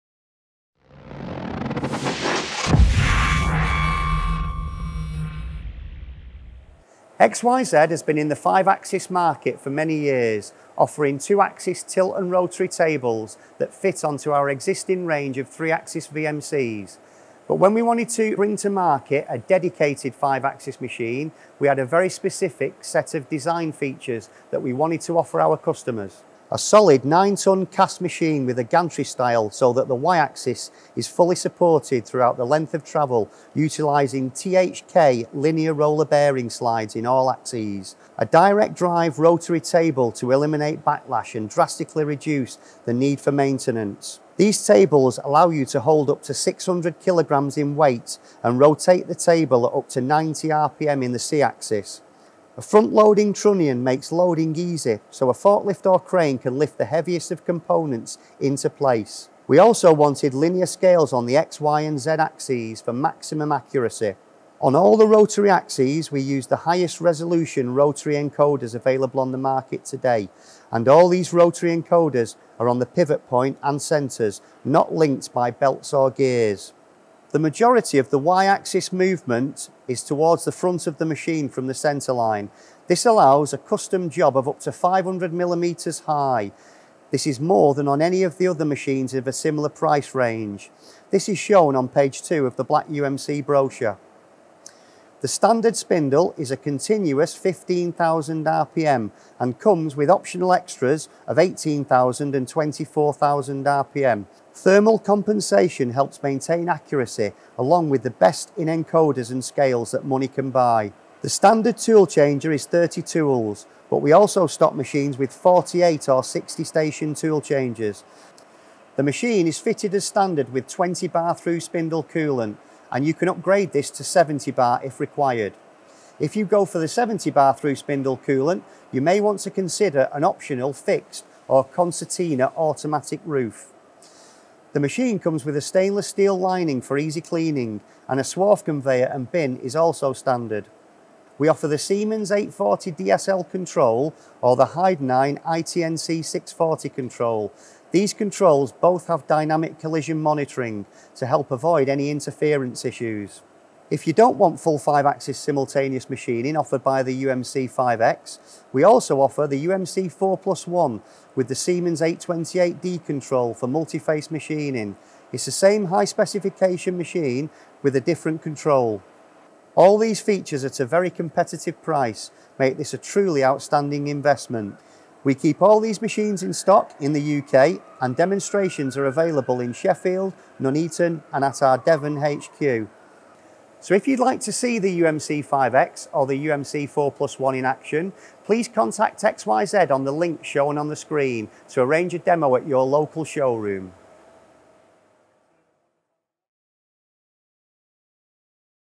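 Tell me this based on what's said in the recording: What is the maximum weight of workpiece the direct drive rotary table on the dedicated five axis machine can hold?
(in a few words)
600 kg.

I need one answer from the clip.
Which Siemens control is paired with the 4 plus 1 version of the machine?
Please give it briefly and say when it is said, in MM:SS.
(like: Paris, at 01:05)
Siemens 828D, at 02:41.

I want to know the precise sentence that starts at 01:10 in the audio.
And all these rotary encoders are on the pivot point and centres, not linked by belts or gears.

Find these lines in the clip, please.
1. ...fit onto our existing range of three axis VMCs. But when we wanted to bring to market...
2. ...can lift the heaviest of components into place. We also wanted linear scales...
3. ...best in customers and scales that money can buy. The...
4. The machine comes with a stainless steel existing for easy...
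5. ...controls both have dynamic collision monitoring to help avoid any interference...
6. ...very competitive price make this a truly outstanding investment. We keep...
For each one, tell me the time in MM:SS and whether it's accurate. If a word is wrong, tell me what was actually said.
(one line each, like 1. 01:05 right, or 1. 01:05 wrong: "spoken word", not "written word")
1. 00:13 right
2. 00:56 right
3. 01:48 wrong: "encoders", not "customers"
4. 02:14 wrong: "lining", not "existing"
5. 02:28 right
6. 02:50 right.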